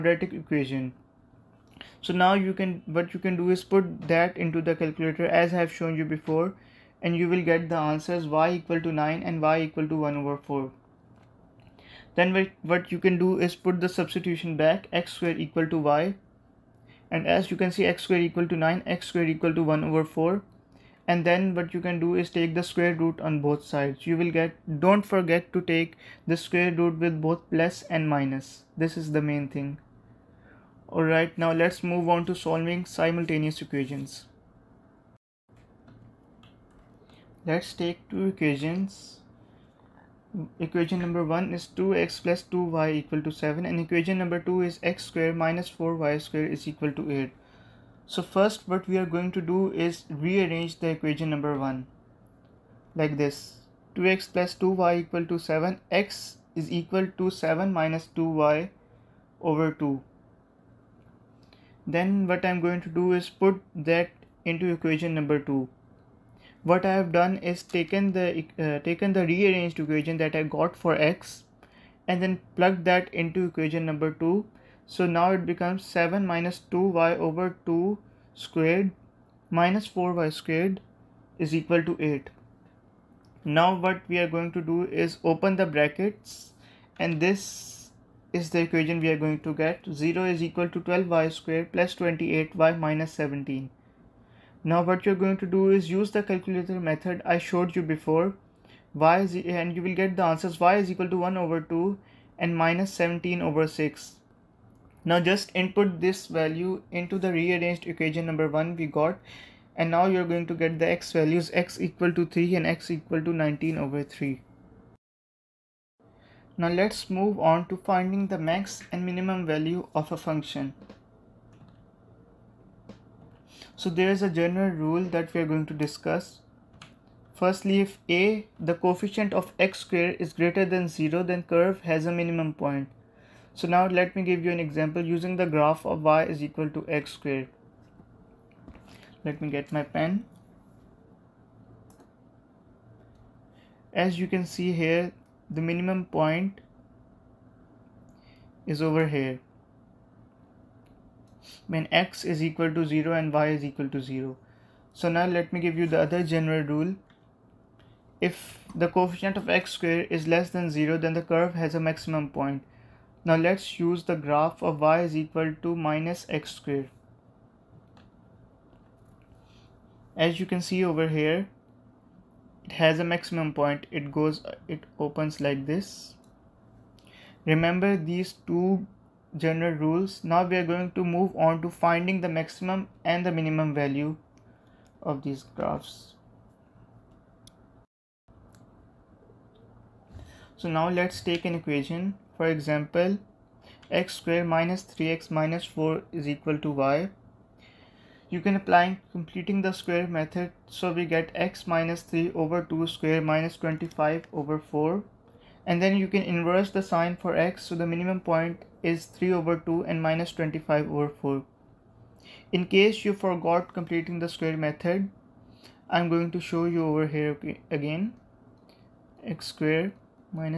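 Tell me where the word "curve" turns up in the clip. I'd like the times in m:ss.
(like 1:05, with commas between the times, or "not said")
2:11, 2:41.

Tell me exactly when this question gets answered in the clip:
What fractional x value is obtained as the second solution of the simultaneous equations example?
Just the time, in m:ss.
1:53.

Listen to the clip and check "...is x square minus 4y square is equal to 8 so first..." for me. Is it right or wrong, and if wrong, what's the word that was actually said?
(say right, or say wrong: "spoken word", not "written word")
right.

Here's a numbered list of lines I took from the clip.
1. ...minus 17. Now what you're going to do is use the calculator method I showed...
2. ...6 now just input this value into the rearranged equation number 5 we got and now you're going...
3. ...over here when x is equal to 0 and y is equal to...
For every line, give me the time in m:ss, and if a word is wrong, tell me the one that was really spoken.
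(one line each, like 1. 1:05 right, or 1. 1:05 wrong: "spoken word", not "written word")
1. 1:32 right
2. 1:43 wrong: "1", not "5"
3. 2:28 right.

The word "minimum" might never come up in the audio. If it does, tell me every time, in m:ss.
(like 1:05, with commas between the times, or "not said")
1:59, 2:12, 2:25, 3:03, 3:27.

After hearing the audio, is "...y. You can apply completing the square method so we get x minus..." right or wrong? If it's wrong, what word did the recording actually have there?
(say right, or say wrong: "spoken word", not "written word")
right.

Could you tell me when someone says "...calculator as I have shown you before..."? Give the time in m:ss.
0:04.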